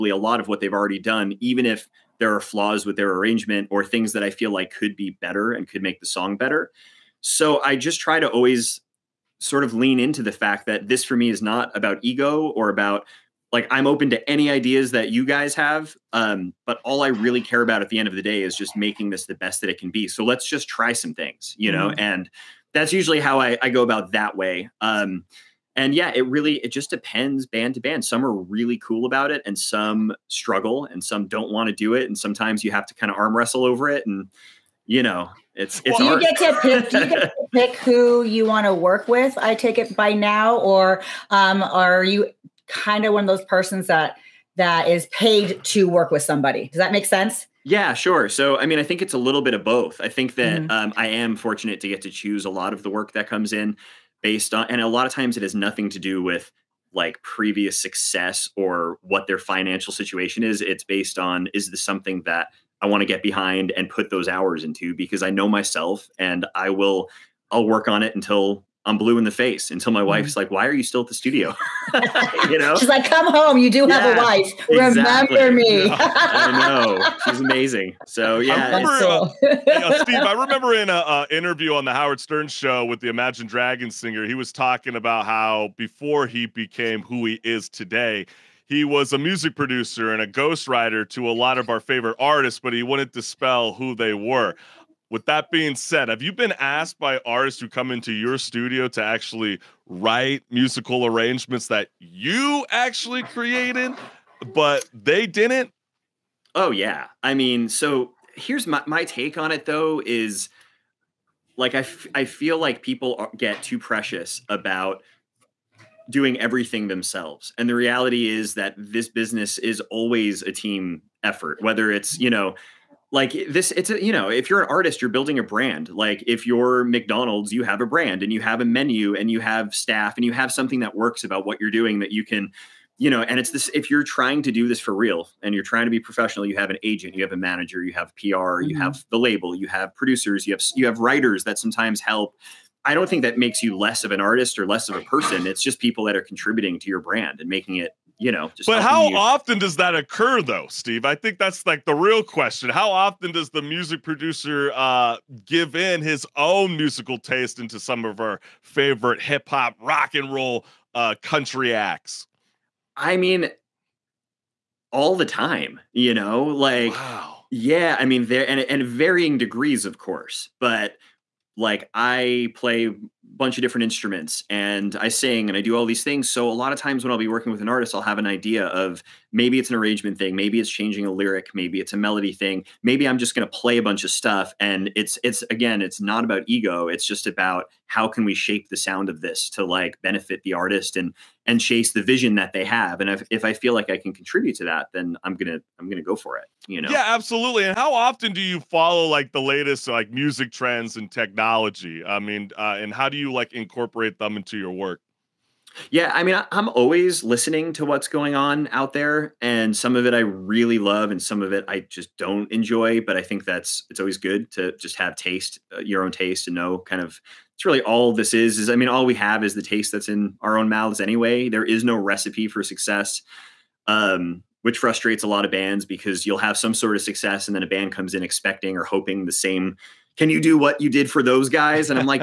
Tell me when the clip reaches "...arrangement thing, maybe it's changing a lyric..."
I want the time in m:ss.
2:59.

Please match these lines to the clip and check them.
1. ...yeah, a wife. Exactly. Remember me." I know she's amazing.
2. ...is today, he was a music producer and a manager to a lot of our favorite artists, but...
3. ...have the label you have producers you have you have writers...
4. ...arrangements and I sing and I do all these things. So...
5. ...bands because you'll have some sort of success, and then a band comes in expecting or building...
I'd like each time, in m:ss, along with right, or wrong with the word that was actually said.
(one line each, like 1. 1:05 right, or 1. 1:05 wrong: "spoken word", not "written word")
1. 1:13 right
2. 1:27 wrong: "ghostwriter", not "manager"
3. 2:18 right
4. 2:53 wrong: "instruments", not "arrangements"
5. 3:45 wrong: "hoping", not "building".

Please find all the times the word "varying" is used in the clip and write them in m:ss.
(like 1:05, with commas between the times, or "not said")
2:48.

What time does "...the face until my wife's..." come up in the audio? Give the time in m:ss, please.
1:09.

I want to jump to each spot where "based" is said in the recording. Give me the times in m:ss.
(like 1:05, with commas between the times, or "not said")
0:54, 1:00.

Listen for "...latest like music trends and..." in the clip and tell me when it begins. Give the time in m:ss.
3:19.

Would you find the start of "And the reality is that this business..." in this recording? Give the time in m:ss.
1:57.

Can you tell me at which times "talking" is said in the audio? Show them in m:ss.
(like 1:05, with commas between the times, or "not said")
1:24.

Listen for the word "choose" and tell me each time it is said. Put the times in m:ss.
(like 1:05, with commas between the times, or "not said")
0:52.